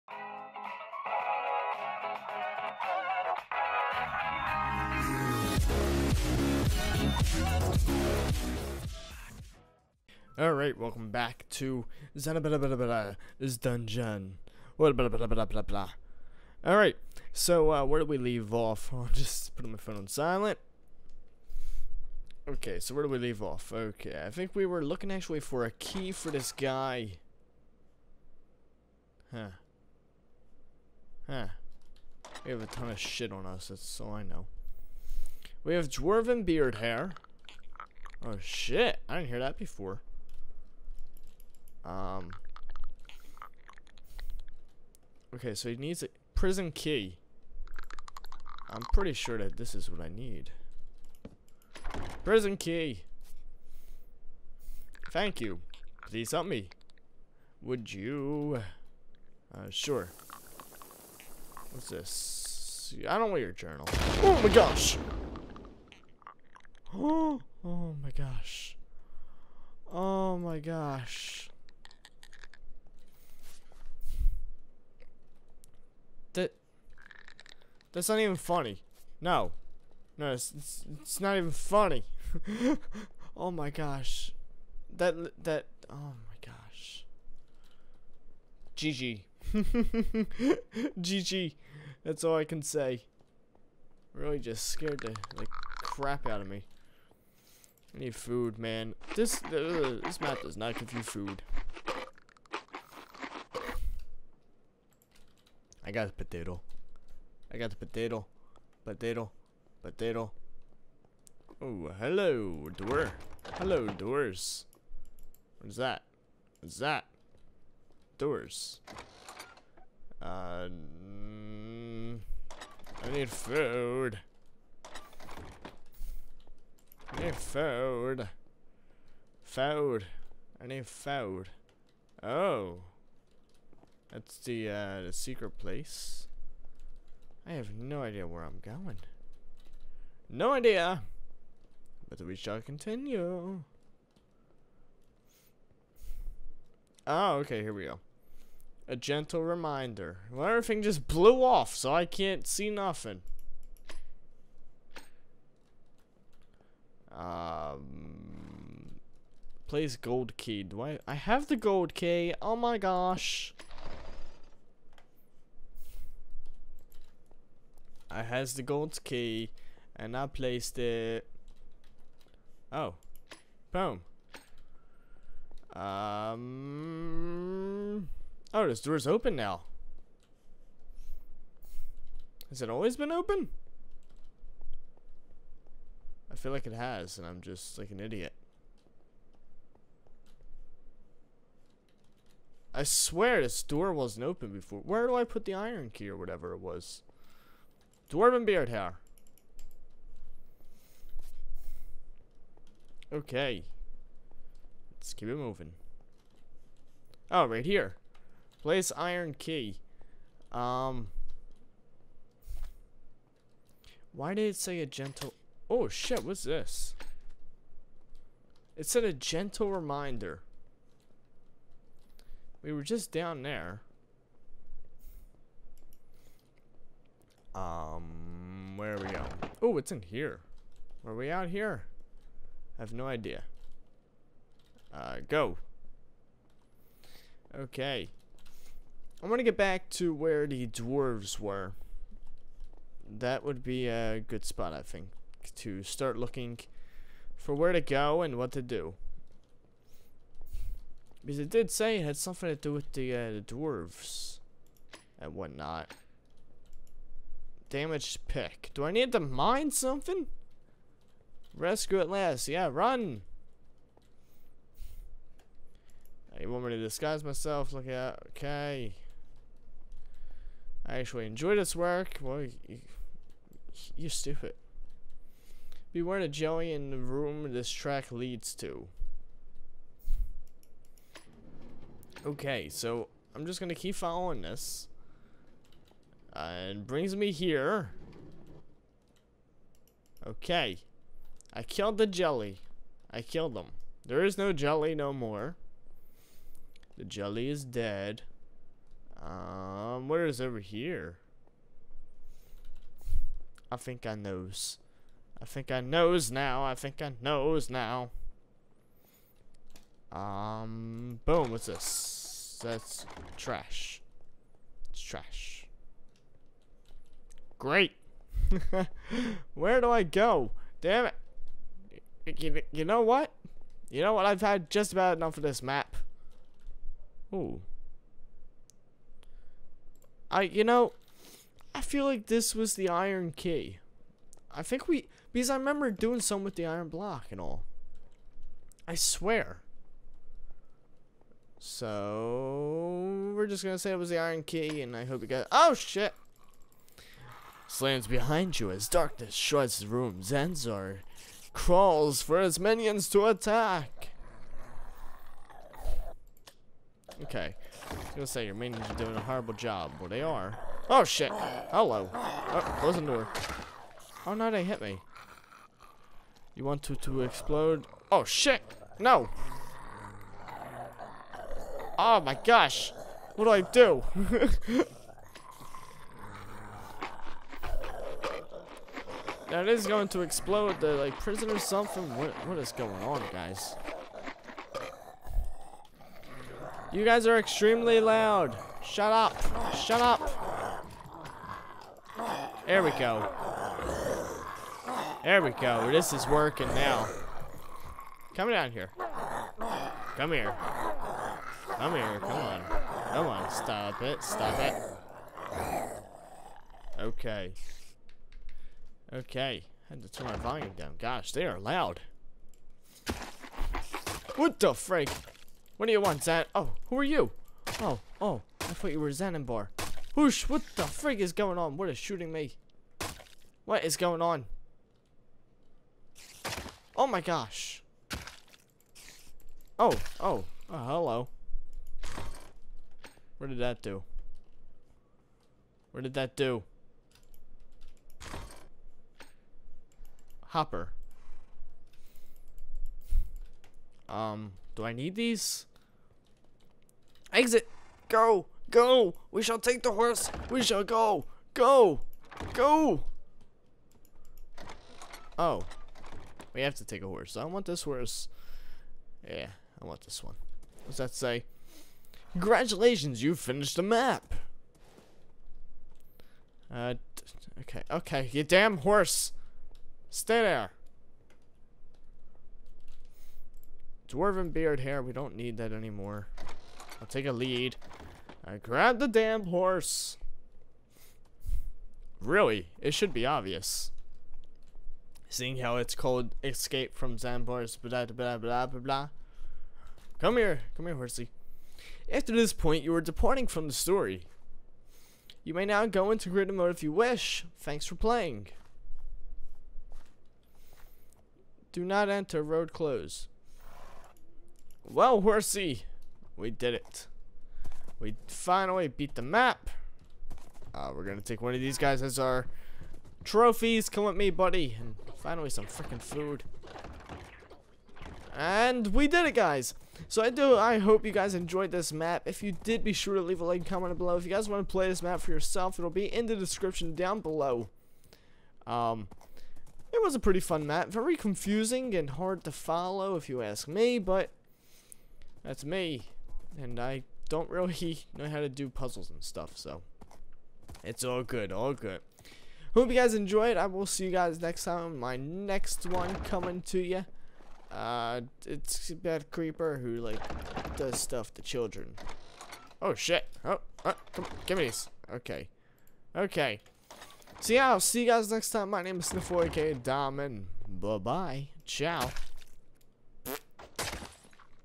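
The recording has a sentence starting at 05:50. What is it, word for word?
Zanzer crawls for his minions to attack.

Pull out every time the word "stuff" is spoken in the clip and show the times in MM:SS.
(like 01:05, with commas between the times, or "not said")
08:59, 09:10.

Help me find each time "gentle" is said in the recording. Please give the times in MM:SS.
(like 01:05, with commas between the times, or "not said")
02:28, 03:34, 03:39.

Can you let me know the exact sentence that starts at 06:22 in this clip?
What what is going on, guys?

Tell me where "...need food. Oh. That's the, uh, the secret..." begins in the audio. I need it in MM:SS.
02:10.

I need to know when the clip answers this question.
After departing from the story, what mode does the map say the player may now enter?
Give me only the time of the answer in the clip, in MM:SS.
08:16.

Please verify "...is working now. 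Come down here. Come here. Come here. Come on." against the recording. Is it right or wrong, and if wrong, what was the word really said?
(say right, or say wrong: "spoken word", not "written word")
right.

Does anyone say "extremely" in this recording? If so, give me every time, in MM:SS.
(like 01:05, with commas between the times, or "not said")
06:27.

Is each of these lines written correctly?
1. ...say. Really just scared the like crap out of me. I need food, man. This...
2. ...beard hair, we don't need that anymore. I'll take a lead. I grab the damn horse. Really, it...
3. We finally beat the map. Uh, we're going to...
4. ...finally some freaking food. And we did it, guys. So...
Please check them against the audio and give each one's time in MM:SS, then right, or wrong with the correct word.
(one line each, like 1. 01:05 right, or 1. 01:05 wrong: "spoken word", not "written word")
1. 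01:32 right
2. 07:54 right
3. 08:27 right
4. 08:35 right.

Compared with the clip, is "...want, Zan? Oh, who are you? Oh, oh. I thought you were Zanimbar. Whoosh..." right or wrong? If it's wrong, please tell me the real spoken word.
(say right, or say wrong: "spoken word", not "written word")
right.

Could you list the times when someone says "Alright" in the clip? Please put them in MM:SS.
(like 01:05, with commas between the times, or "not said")
00:10, 00:14.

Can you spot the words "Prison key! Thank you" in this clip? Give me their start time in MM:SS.
00:52.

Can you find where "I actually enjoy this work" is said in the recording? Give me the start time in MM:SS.
04:30.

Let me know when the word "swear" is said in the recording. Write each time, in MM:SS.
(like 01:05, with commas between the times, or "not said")
03:12, 05:38.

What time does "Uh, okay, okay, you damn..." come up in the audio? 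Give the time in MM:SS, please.
07:46.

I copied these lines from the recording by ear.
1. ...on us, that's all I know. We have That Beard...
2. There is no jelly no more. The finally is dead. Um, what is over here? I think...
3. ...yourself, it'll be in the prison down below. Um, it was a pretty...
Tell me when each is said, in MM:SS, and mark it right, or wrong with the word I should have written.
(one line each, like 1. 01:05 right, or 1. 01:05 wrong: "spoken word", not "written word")
1. 00:33 wrong: "Dwarven", not "That"
2. 04:54 wrong: "jelly", not "finally"
3. 08:45 wrong: "description", not "prison".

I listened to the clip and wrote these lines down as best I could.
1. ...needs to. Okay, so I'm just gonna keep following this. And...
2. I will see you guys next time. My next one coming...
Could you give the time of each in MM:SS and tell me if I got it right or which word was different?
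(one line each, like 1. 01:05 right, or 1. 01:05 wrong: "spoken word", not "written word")
1. 04:38 wrong: "leads", not "needs"
2. 09:03 right.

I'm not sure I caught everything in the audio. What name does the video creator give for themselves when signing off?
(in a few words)
Sniff4K Diamond.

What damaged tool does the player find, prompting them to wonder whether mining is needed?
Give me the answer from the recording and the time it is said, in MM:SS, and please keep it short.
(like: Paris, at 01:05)
Damaged pick, at 04:17.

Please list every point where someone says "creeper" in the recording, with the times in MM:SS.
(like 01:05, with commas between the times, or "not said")
09:09.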